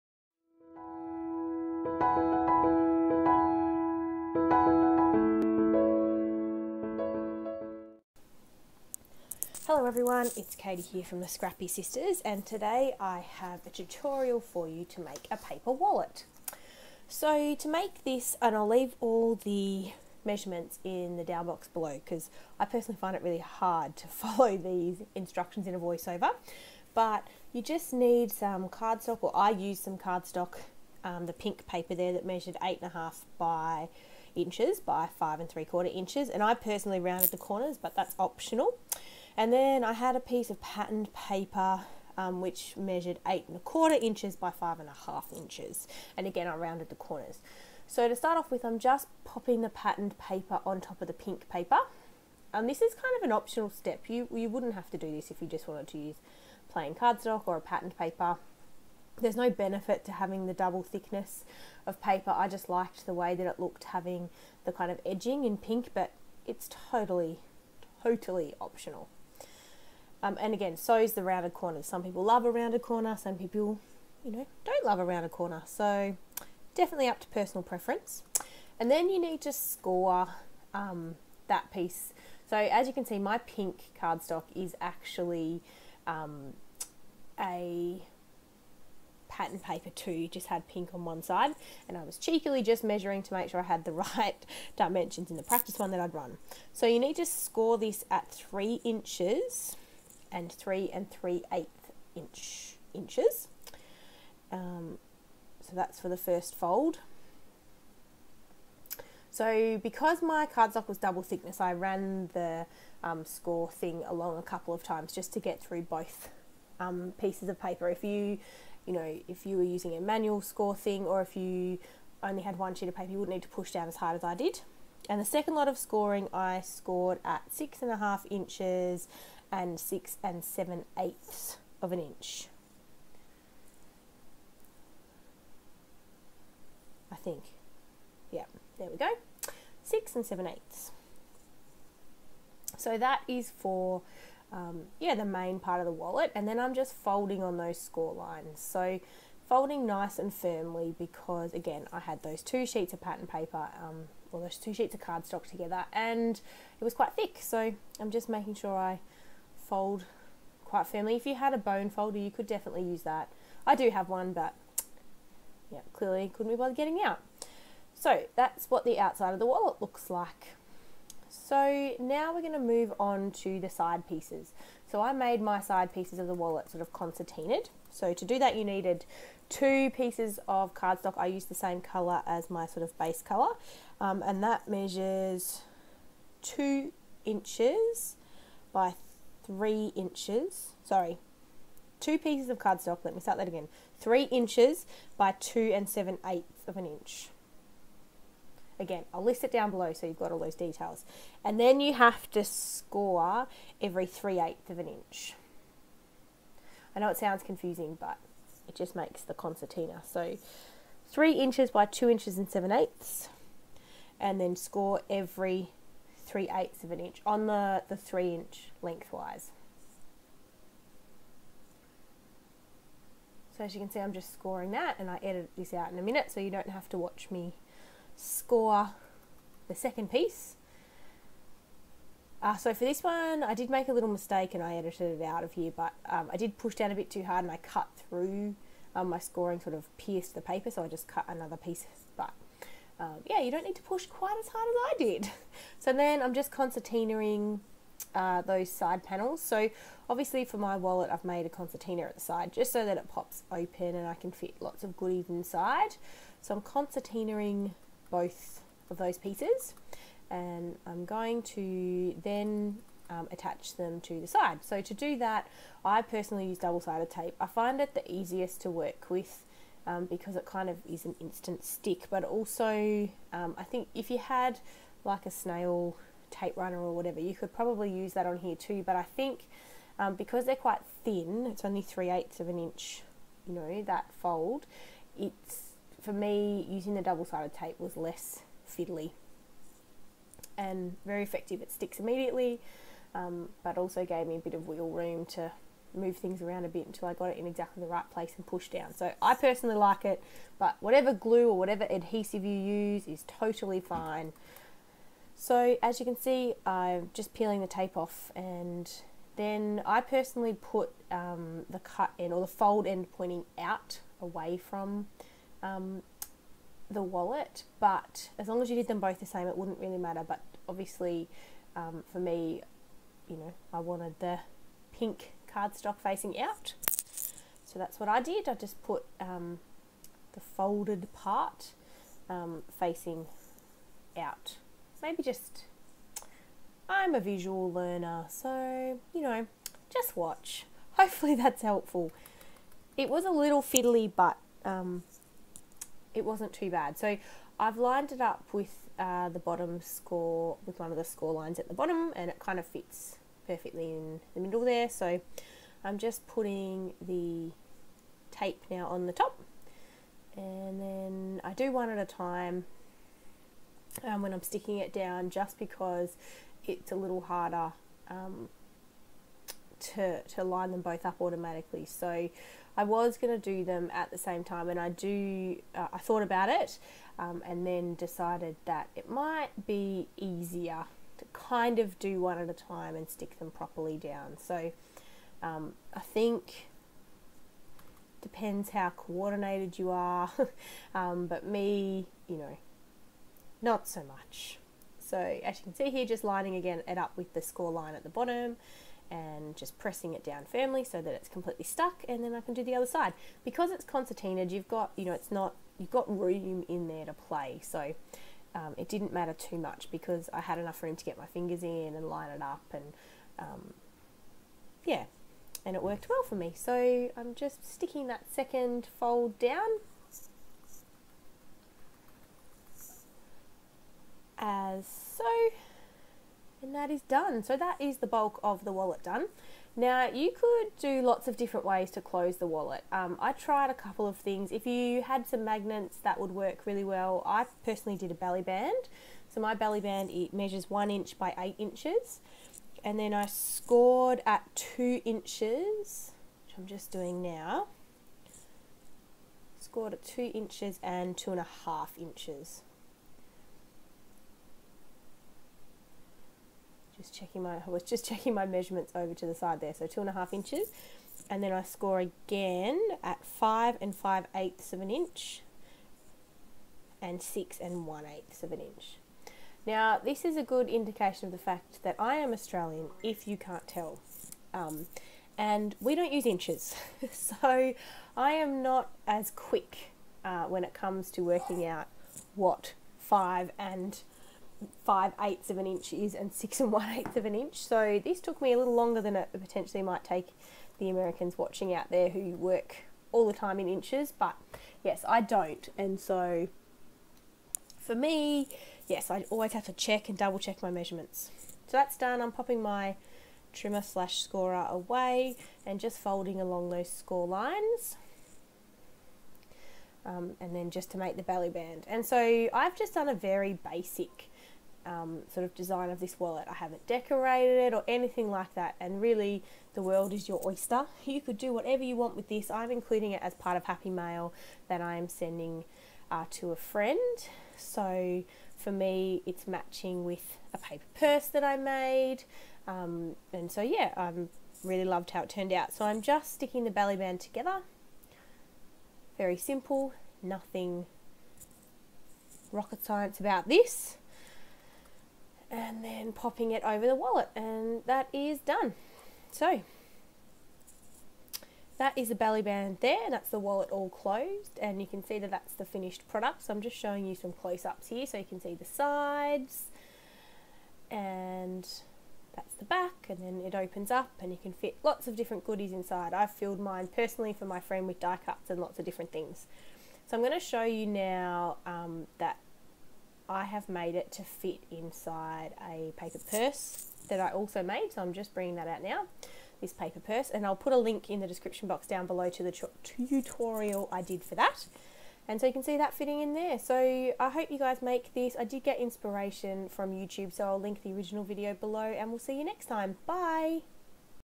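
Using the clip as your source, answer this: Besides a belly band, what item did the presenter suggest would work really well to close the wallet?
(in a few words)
Magnets.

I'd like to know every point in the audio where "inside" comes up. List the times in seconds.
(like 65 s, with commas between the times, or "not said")
255 s, 565 s, 574 s.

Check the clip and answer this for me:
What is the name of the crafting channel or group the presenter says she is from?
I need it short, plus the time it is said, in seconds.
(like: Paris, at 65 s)
Scrappy Sisters, at 11 s.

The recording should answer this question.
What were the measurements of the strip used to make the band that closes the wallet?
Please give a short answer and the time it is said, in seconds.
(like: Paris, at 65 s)
1 by 8 inches, at 440 s.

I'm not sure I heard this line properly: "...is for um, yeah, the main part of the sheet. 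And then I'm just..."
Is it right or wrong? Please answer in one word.
wrong.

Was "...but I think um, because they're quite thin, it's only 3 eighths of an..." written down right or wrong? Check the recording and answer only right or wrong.
right.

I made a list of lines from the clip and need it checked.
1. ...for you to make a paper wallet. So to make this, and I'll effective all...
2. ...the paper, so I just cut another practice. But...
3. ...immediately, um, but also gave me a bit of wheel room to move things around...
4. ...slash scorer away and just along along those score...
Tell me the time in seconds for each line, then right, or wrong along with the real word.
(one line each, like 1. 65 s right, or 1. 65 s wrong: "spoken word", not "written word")
1. 14 s wrong: "leave", not "effective"
2. 240 s wrong: "piece", not "practice"
3. 291 s right
4. 503 s wrong: "folding", not "along".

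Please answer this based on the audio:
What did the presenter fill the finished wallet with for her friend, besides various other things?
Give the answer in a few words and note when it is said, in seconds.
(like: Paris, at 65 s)
Die cuts, at 567 s.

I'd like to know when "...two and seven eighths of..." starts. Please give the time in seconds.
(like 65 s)
195 s.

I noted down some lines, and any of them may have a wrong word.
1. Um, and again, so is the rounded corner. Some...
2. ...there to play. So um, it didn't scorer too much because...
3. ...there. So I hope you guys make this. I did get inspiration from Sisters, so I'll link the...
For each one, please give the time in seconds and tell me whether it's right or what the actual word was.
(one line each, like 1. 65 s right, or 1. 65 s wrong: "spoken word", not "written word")
1. 70 s right
2. 406 s wrong: "matter", not "scorer"
3. 586 s wrong: "YouTube", not "Sisters".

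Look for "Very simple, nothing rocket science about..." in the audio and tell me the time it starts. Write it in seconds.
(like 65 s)
539 s.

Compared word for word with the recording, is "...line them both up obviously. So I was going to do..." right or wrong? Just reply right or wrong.
wrong.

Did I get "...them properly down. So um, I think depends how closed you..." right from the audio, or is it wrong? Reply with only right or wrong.
wrong.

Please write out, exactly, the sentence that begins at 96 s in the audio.
So you need to score this at 3 inches and 3 and three eighth inch inches.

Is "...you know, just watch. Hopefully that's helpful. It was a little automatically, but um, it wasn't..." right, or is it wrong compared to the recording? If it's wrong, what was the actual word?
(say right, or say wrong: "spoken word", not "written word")
wrong: "fiddly", not "automatically".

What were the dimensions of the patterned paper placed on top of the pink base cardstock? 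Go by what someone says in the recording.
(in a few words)
8 1/4 by 5 1/2 inches.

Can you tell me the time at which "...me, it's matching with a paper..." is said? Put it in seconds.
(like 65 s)
528 s.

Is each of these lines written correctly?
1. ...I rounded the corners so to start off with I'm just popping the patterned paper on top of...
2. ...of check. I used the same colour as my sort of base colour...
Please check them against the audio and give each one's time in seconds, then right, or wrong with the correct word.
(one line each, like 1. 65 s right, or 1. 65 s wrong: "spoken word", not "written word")
1. 46 s right
2. 180 s wrong: "cardstock", not "check".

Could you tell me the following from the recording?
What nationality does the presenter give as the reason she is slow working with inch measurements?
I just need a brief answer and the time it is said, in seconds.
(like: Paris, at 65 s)
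Australian, at 472 s.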